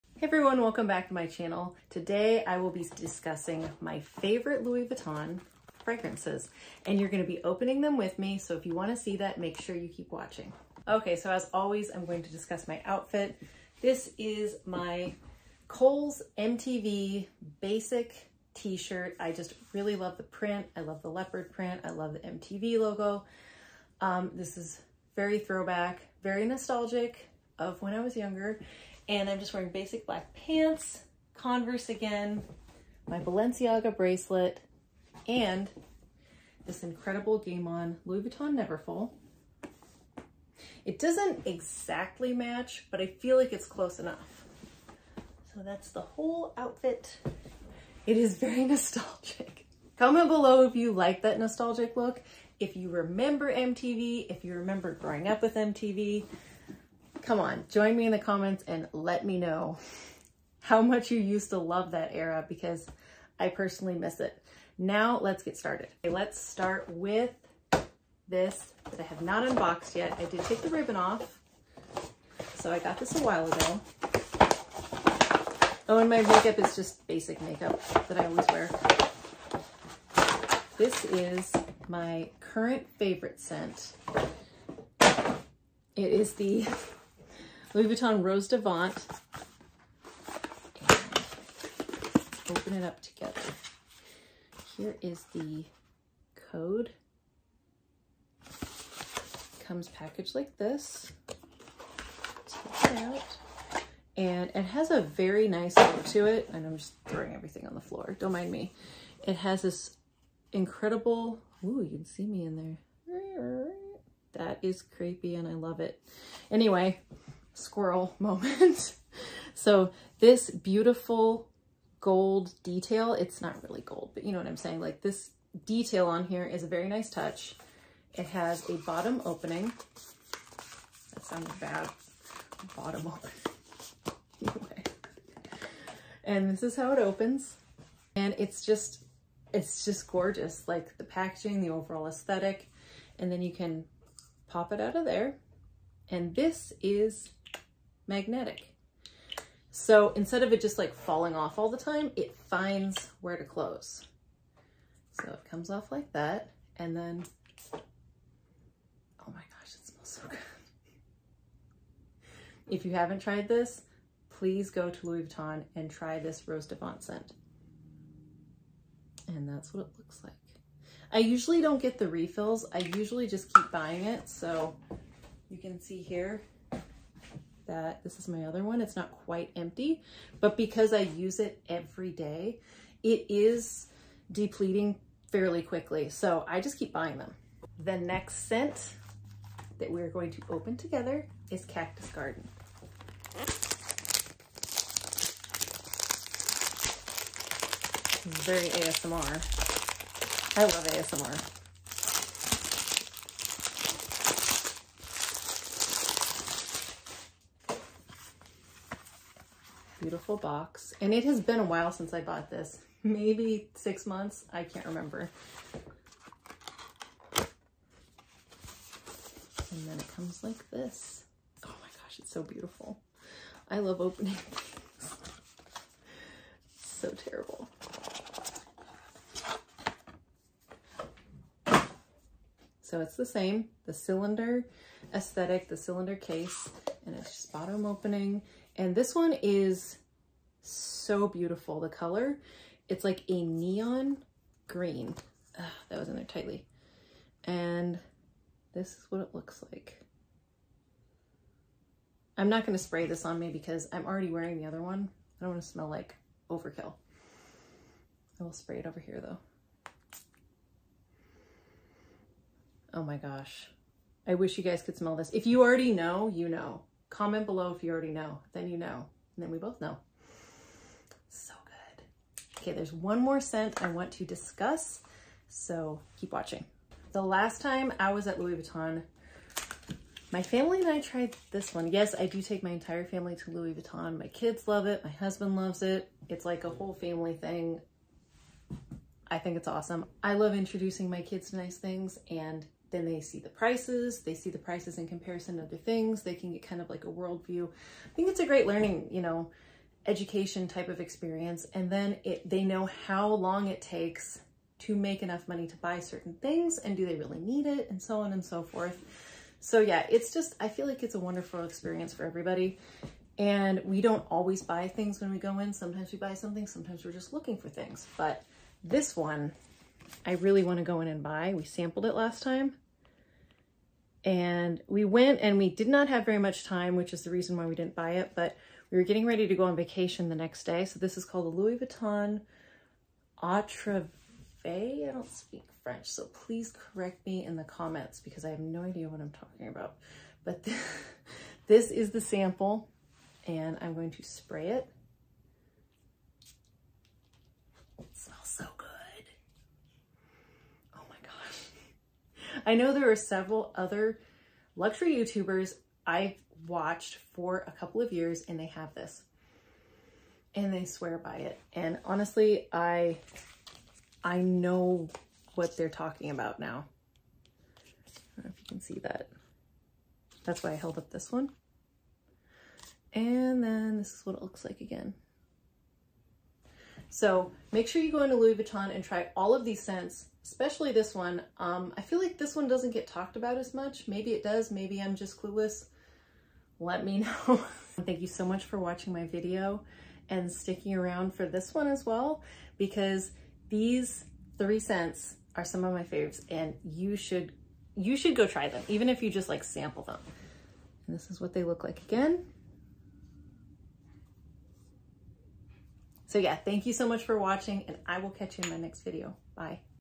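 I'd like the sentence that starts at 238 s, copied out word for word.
And this one is so beautiful, the color.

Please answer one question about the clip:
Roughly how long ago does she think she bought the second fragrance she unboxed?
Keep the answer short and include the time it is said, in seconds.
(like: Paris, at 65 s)
6 months, at 213 s.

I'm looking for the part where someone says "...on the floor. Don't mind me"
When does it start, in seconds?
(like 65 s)
107 s.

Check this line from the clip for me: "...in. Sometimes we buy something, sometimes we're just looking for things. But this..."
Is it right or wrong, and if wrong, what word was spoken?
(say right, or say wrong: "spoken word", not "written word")
right.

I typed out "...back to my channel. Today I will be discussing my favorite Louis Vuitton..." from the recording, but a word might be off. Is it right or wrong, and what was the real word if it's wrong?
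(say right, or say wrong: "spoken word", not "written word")
right.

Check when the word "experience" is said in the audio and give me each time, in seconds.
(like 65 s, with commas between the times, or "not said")
300 s, 311 s.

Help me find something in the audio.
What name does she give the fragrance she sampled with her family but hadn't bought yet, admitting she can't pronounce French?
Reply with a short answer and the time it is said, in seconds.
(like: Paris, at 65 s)
Atreve, at 333 s.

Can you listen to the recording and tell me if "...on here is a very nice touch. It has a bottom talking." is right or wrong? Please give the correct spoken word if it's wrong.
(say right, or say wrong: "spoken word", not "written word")
wrong: "opening", not "talking".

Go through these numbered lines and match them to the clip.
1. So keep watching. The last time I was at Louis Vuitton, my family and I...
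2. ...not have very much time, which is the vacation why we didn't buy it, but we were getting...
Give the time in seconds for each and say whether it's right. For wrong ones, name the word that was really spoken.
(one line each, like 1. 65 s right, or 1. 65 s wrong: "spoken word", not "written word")
1. 275 s right
2. 325 s wrong: "reason", not "vacation".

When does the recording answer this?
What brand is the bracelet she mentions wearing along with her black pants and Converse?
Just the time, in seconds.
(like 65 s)
33 s.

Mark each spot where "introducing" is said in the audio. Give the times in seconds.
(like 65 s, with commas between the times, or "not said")
290 s.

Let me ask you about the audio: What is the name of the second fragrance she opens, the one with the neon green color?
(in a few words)
Cactus Garden.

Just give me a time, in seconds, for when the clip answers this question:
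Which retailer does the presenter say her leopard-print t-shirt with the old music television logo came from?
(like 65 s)
15 s.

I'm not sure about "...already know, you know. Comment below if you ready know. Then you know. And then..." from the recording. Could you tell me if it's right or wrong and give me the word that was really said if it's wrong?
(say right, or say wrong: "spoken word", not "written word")
wrong: "already", not "ready".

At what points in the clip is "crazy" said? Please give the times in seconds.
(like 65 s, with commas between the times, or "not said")
not said.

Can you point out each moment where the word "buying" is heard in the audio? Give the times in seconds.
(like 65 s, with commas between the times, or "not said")
173 s, 186 s.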